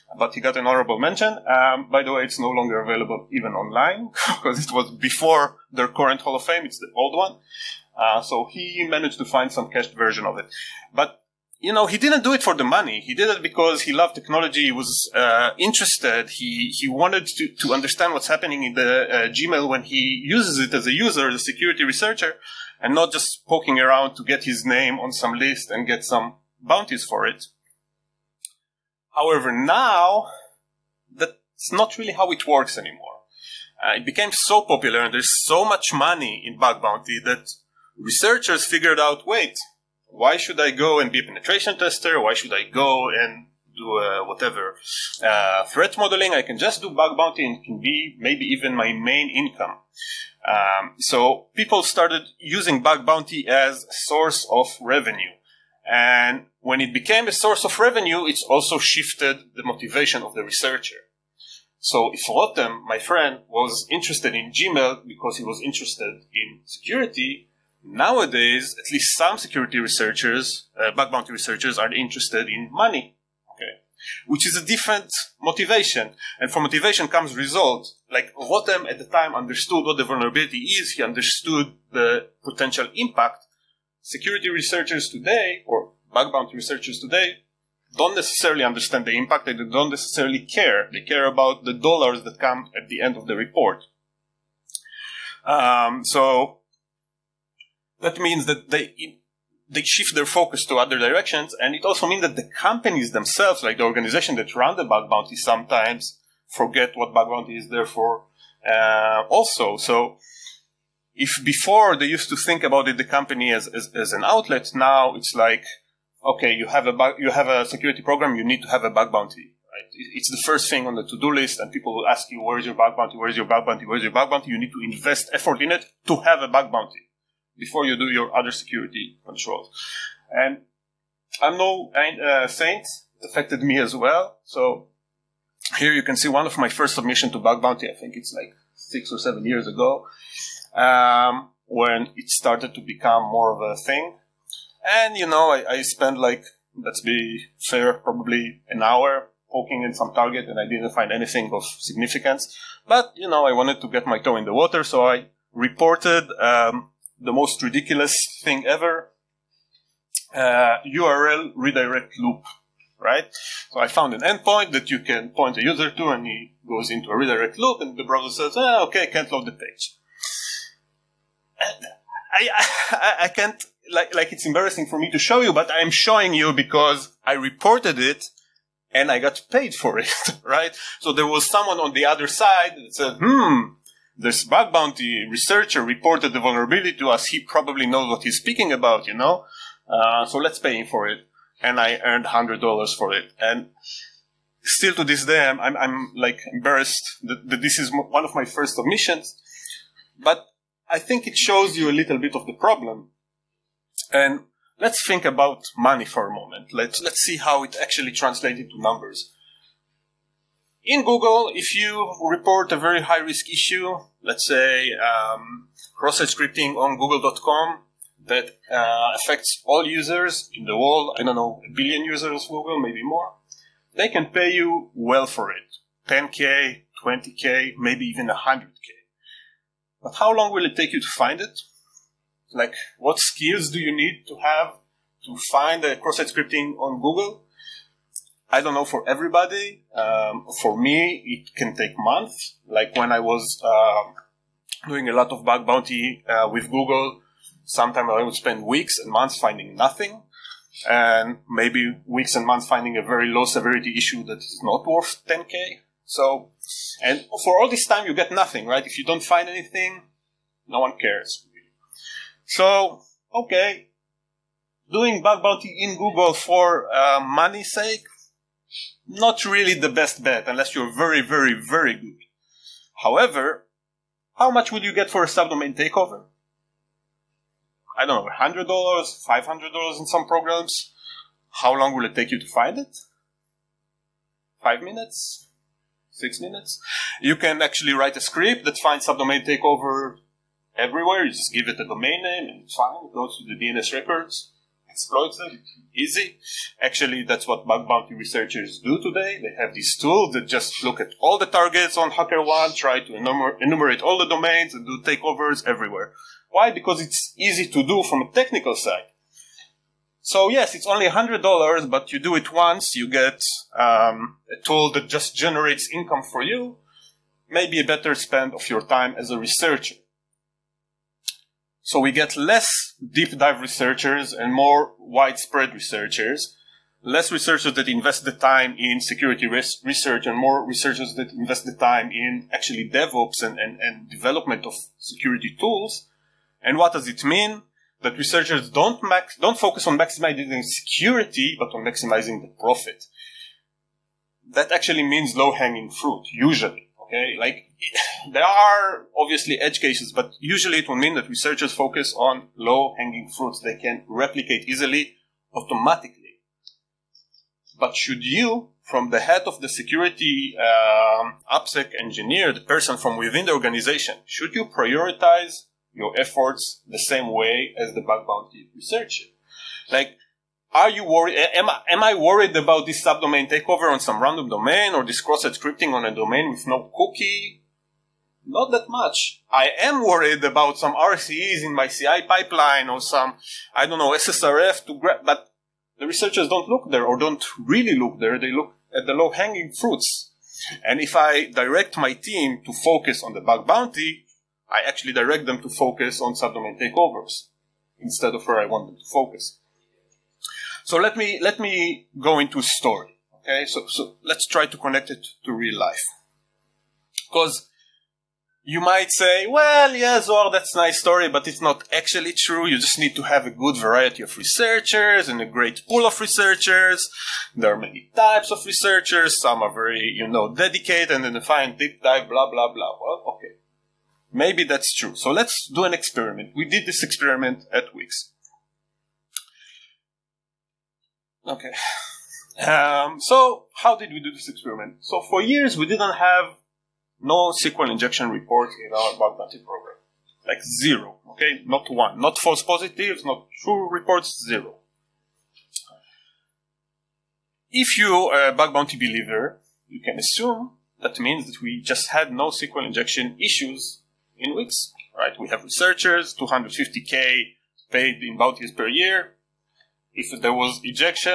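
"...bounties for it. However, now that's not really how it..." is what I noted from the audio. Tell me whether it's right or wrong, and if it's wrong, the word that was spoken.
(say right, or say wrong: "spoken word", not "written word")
right.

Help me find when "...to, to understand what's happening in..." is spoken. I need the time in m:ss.
0:17.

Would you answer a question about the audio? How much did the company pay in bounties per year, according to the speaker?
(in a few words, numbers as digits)
250k.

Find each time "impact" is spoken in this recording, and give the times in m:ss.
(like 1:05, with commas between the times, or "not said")
1:22, 1:29.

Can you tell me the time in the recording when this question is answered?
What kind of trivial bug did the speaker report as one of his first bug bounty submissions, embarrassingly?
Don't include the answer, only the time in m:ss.
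2:40.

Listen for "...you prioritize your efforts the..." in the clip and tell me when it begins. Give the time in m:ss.
6:04.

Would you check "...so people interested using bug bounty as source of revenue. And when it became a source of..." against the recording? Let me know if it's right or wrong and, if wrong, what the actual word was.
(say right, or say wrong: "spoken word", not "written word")
wrong: "started", not "interested".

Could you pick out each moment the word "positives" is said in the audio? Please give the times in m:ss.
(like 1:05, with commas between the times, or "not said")
7:22.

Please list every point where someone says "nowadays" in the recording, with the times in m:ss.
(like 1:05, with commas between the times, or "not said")
1:07.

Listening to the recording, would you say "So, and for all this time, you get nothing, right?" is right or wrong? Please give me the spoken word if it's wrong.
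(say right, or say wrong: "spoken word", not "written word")
right.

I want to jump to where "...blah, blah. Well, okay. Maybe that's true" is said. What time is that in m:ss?
7:02.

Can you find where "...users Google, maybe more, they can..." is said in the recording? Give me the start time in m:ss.
3:42.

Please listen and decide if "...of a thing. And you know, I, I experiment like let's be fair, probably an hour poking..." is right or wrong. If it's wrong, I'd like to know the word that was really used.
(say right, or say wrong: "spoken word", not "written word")
wrong: "spent", not "experiment".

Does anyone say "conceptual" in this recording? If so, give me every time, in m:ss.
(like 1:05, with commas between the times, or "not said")
not said.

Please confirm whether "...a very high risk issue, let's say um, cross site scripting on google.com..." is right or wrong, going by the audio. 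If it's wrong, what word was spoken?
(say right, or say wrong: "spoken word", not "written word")
right.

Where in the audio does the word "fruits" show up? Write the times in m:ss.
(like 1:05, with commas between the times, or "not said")
5:45, 5:53, 6:29.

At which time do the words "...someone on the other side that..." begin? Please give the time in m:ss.
3:01.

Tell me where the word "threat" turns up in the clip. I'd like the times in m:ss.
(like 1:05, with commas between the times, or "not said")
0:45.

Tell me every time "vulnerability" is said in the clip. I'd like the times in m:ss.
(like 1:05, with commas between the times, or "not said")
1:20, 3:06.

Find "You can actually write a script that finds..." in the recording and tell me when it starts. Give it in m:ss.
4:47.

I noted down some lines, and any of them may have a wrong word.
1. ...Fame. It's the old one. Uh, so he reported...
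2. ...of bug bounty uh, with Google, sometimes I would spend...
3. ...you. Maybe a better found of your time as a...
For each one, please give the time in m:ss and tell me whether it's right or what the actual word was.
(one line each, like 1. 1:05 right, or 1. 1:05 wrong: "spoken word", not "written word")
1. 0:06 wrong: "managed", not "reported"
2. 4:05 right
3. 5:16 wrong: "spend", not "found".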